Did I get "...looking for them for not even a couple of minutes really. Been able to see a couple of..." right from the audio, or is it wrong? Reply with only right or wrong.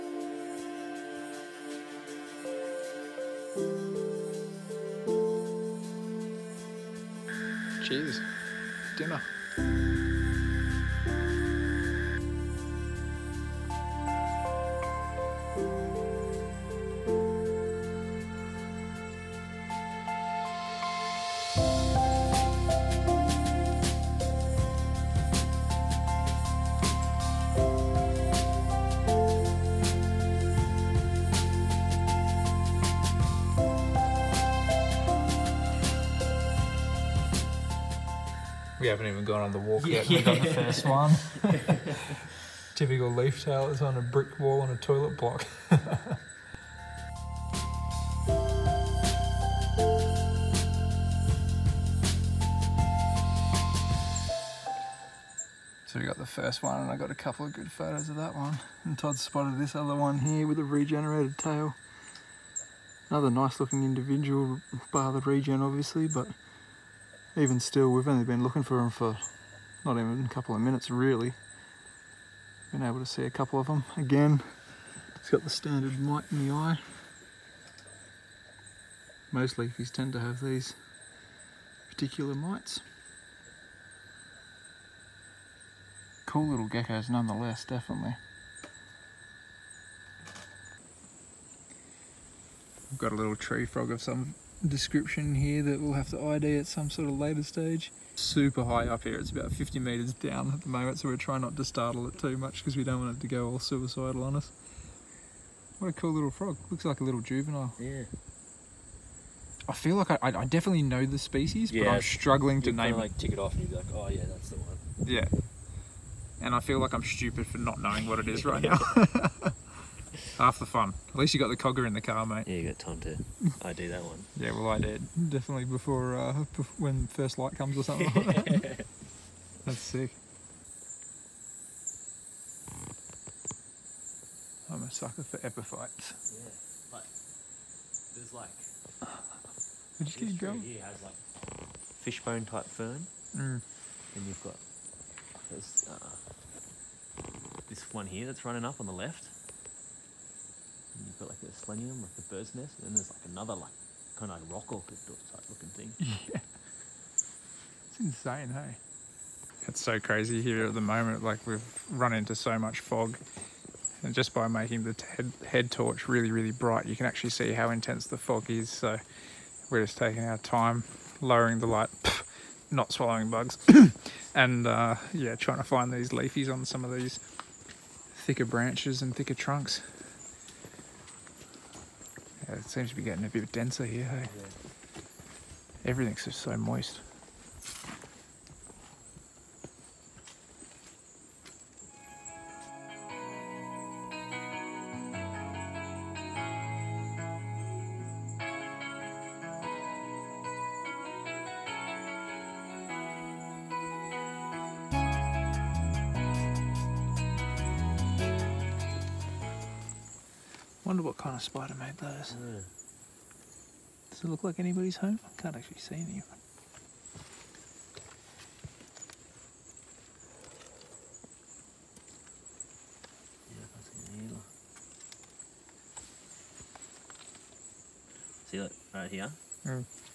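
right.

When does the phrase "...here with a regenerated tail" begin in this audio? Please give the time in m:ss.
1:00.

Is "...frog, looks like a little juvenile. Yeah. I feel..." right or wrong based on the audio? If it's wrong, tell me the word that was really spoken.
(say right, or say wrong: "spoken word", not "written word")
right.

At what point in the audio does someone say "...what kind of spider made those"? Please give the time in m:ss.
3:31.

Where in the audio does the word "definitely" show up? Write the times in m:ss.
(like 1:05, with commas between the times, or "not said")
1:27, 1:50, 2:05.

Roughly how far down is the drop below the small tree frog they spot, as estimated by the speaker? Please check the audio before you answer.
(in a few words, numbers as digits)
50 metres.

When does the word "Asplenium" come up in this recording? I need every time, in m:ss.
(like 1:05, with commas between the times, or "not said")
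2:31.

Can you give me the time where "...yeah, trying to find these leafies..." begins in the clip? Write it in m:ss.
2:55.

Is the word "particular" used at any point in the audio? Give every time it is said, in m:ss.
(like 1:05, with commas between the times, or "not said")
1:21.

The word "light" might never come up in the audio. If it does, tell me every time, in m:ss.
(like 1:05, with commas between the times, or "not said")
2:07, 2:51.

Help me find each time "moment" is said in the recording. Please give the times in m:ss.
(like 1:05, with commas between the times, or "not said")
1:40, 2:40.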